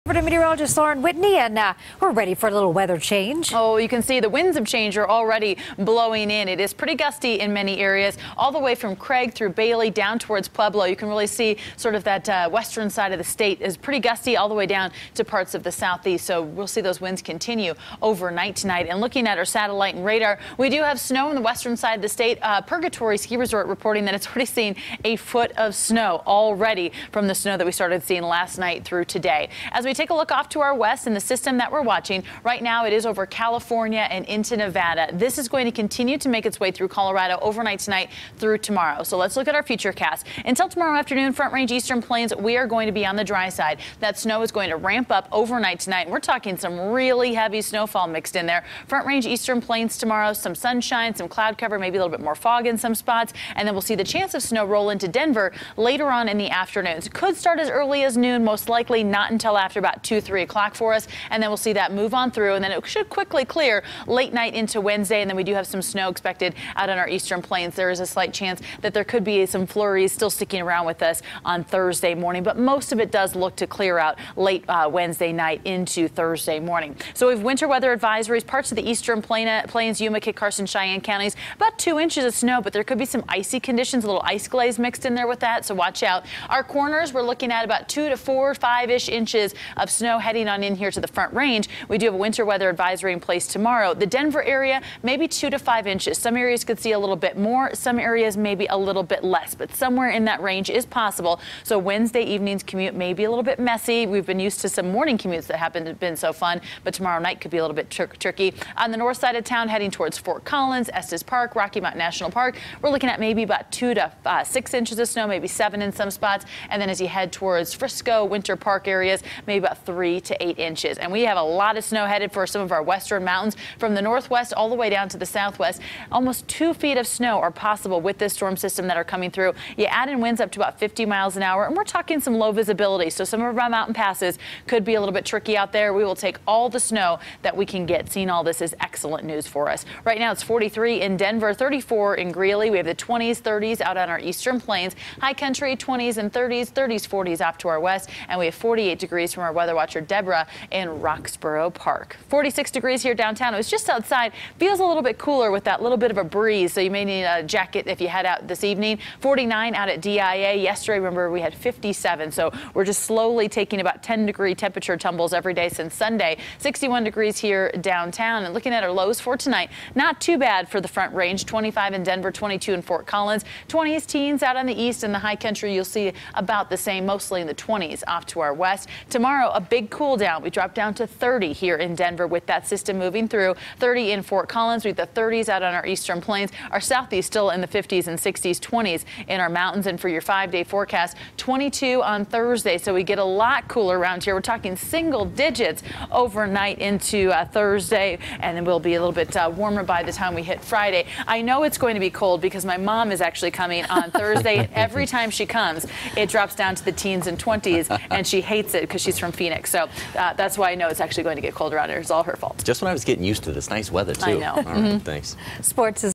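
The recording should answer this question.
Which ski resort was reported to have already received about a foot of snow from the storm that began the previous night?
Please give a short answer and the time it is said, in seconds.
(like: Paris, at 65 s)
Purgatory, at 22 s.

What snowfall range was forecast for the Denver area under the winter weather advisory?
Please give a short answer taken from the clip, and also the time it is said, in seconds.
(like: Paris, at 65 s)
2 to 5 inches, at 95 s.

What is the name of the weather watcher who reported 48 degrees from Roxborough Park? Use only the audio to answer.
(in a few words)
Deborah.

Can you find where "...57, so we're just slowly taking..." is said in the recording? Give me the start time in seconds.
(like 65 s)
161 s.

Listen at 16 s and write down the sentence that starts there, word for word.
So we'll see those winds continue overnight tonight.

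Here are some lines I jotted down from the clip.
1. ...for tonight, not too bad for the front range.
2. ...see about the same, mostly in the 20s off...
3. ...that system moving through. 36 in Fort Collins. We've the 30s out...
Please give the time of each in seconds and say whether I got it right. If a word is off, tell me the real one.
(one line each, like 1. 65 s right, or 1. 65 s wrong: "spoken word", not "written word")
1. 169 s right
2. 175 s right
3. 182 s wrong: "30", not "36".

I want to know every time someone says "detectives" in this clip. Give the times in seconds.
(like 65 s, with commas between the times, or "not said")
not said.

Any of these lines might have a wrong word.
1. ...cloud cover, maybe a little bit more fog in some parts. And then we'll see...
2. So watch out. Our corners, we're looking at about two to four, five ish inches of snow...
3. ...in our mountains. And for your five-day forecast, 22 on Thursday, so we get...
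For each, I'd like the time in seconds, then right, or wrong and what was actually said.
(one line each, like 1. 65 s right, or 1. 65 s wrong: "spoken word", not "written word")
1. 51 s wrong: "spots", not "parts"
2. 85 s right
3. 189 s right.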